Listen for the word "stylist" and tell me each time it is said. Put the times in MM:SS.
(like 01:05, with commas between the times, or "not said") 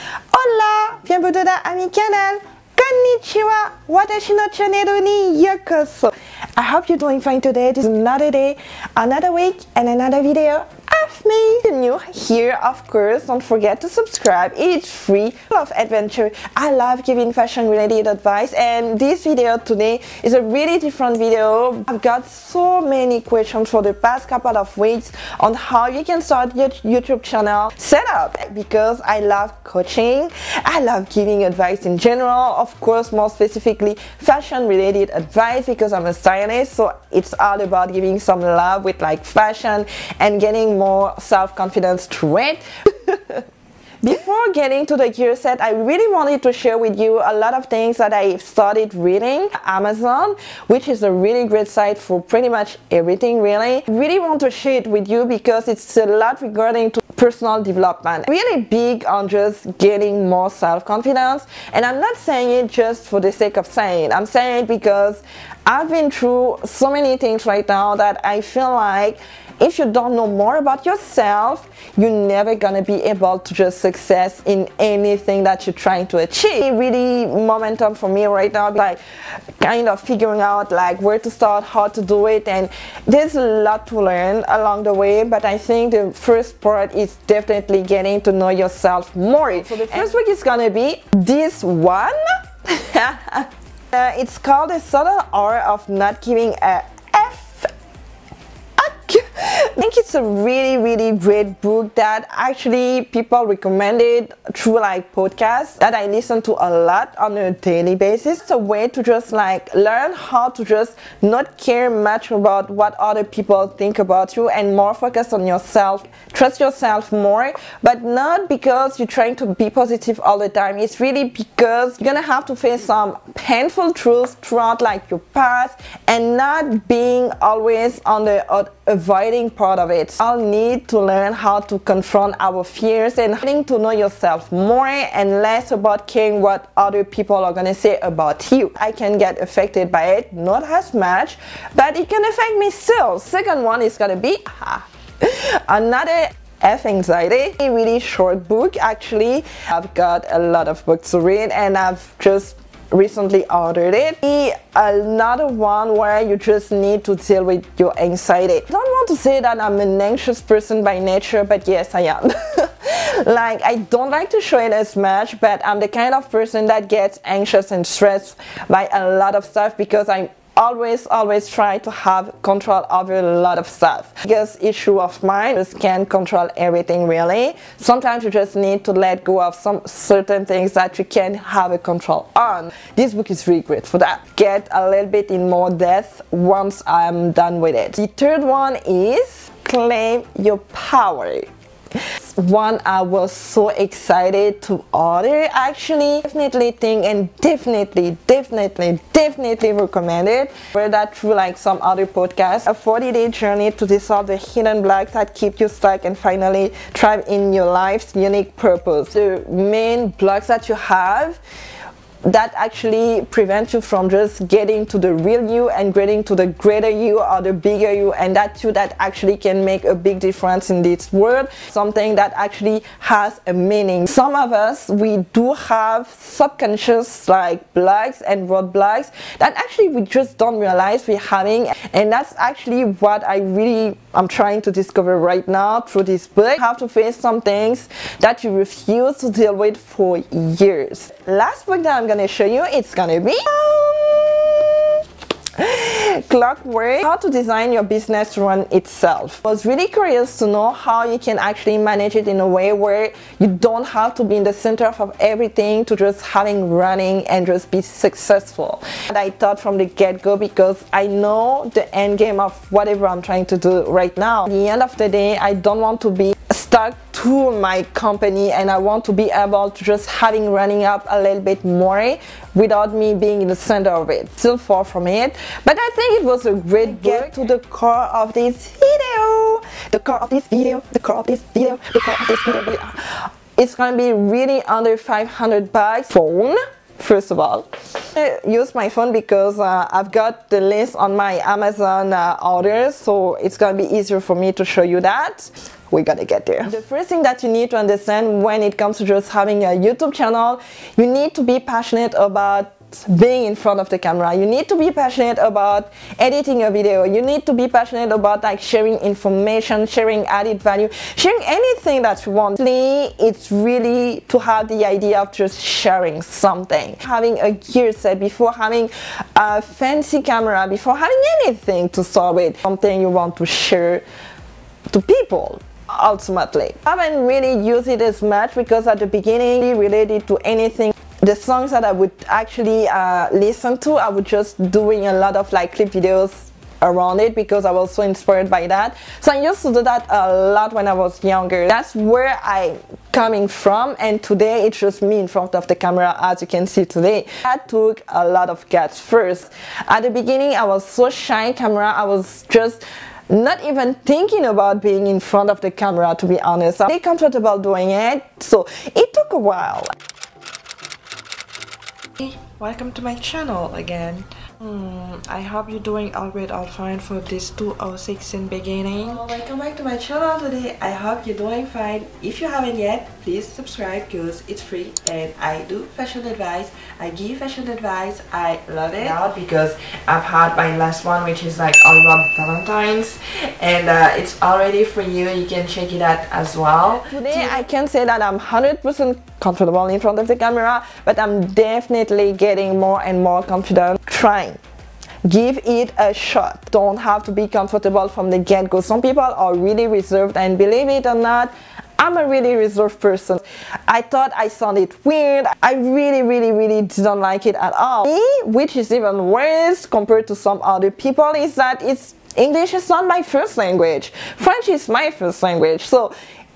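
00:36.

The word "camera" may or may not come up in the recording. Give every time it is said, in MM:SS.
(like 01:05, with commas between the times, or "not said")
05:03, 05:20, 05:45, 05:51, 05:55, 06:30.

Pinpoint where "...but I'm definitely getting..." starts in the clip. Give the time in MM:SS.
06:31.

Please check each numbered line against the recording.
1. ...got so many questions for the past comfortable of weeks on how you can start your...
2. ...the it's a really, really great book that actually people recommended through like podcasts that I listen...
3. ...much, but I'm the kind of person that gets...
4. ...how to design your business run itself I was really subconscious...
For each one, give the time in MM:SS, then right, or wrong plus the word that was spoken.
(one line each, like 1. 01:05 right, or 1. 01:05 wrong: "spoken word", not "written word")
1. 00:22 wrong: "couple", not "comfortable"
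2. 01:39 right
3. 02:44 right
4. 04:07 wrong: "curious", not "subconscious".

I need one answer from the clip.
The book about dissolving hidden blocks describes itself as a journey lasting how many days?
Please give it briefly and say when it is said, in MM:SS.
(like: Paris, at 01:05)
40, at 03:22.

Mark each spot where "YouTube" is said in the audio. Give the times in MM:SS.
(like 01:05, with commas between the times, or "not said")
00:26, 04:59.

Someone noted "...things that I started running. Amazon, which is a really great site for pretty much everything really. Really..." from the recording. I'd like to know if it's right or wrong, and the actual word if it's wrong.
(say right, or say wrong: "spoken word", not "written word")
wrong: "reading", not "running".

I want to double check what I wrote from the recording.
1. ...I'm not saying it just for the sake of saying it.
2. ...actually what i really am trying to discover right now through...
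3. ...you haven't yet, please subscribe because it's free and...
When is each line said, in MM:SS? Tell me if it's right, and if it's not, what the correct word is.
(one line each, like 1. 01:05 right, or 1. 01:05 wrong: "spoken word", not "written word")
1. 01:01 right
2. 03:52 right
3. 06:12 right.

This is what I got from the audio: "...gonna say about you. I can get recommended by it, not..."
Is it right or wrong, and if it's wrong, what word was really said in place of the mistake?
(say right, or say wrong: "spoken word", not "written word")
wrong: "affected", not "recommended".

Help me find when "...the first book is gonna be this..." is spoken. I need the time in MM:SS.
01:29.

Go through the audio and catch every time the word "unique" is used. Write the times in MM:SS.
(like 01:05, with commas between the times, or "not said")
03:28.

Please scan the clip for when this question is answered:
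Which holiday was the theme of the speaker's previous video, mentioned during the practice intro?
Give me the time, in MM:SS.
06:22.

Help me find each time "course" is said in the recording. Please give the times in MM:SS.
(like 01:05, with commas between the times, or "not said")
00:12, 00:32.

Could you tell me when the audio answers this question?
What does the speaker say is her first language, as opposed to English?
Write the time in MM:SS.
06:54.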